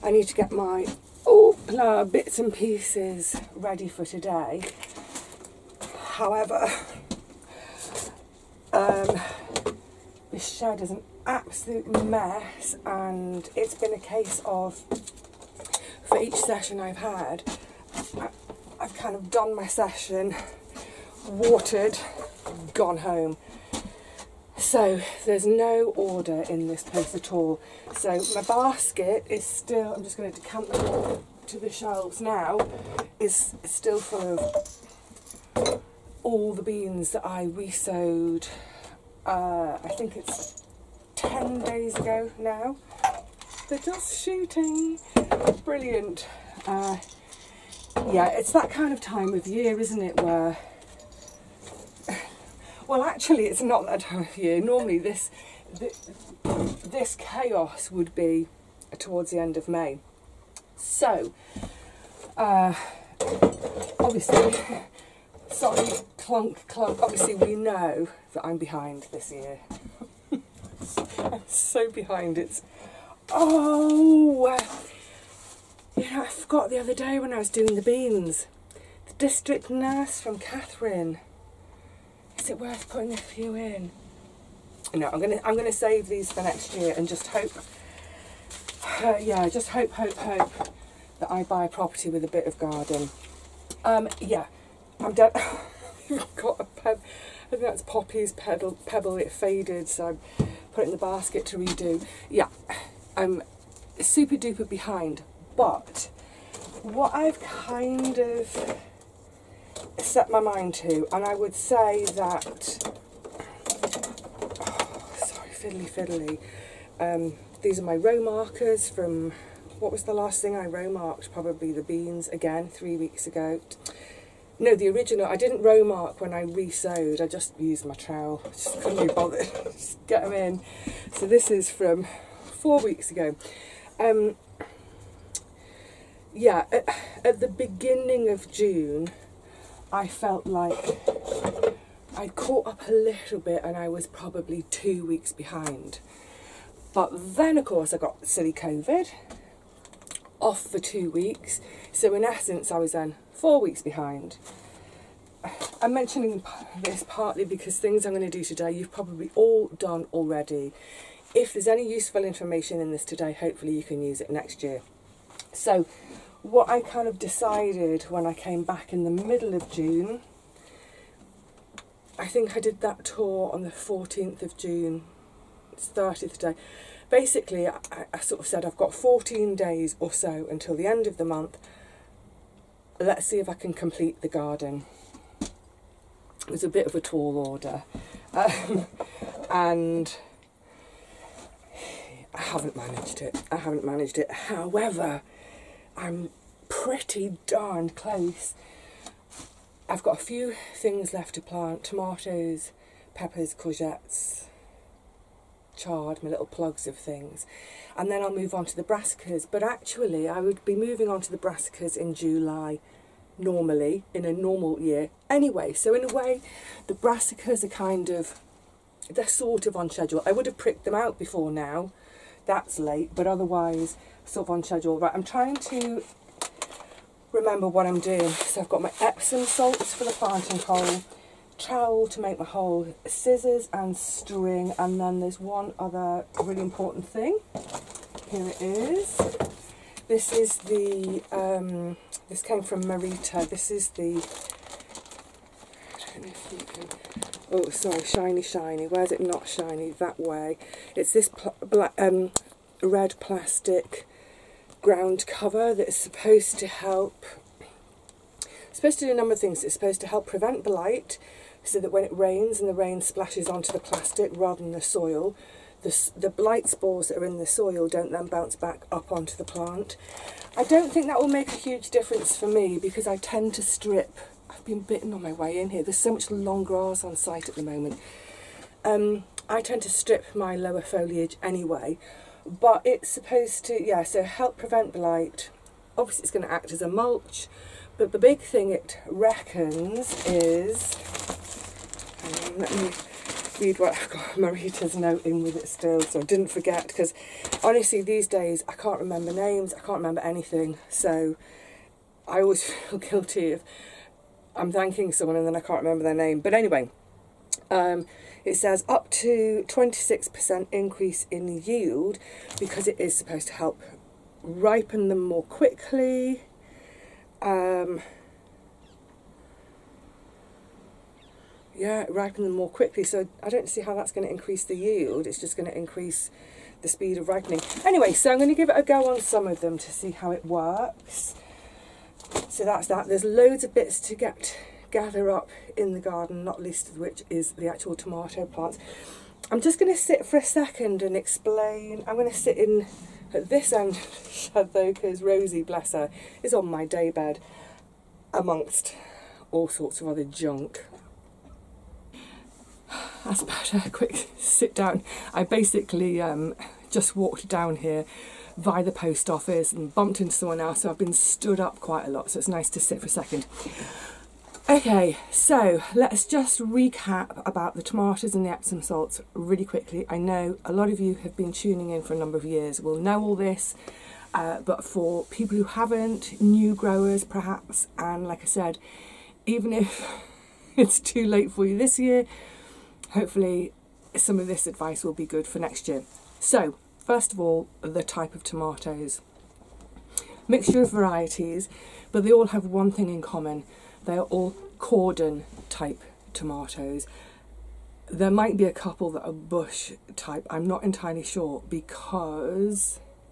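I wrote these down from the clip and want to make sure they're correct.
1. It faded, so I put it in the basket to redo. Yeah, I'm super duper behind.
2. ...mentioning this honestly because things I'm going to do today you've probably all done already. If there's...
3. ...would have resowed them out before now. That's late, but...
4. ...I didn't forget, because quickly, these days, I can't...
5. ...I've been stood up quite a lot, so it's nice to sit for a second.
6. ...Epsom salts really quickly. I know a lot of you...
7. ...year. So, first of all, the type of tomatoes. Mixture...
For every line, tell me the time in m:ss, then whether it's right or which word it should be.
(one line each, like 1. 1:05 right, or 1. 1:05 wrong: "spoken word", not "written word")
1. 1:39 right
2. 2:35 wrong: "partly", not "honestly"
3. 3:40 wrong: "pricked", not "resowed"
4. 4:56 wrong: "honestly", not "quickly"
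5. 6:00 right
6. 6:08 right
7. 6:25 right.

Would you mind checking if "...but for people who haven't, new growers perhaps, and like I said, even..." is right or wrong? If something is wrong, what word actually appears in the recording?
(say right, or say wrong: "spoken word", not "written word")
right.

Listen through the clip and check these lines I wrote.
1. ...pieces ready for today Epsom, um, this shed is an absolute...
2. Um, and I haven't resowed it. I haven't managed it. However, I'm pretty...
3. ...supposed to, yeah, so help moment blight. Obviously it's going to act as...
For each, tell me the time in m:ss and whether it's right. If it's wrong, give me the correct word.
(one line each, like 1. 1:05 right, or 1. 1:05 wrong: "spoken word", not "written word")
1. 0:02 wrong: "However", not "Epsom"
2. 3:08 wrong: "managed", not "resowed"
3. 4:43 wrong: "prevent", not "moment".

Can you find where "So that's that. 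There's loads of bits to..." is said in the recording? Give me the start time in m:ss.
5:32.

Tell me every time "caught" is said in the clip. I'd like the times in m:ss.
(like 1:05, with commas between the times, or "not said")
2:22.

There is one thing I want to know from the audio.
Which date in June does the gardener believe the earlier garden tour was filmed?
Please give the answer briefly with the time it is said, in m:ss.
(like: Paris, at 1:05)
14th of June, at 2:53.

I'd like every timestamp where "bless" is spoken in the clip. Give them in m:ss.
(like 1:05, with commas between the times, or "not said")
5:45.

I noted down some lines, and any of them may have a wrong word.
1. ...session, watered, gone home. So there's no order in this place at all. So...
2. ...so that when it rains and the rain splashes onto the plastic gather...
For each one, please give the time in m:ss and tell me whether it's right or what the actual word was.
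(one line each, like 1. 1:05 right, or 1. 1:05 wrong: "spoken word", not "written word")
1. 0:19 right
2. 4:21 wrong: "rather", not "gather".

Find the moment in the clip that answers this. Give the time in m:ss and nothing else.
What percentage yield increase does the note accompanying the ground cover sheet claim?
5:09.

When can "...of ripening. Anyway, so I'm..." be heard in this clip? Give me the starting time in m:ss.
5:27.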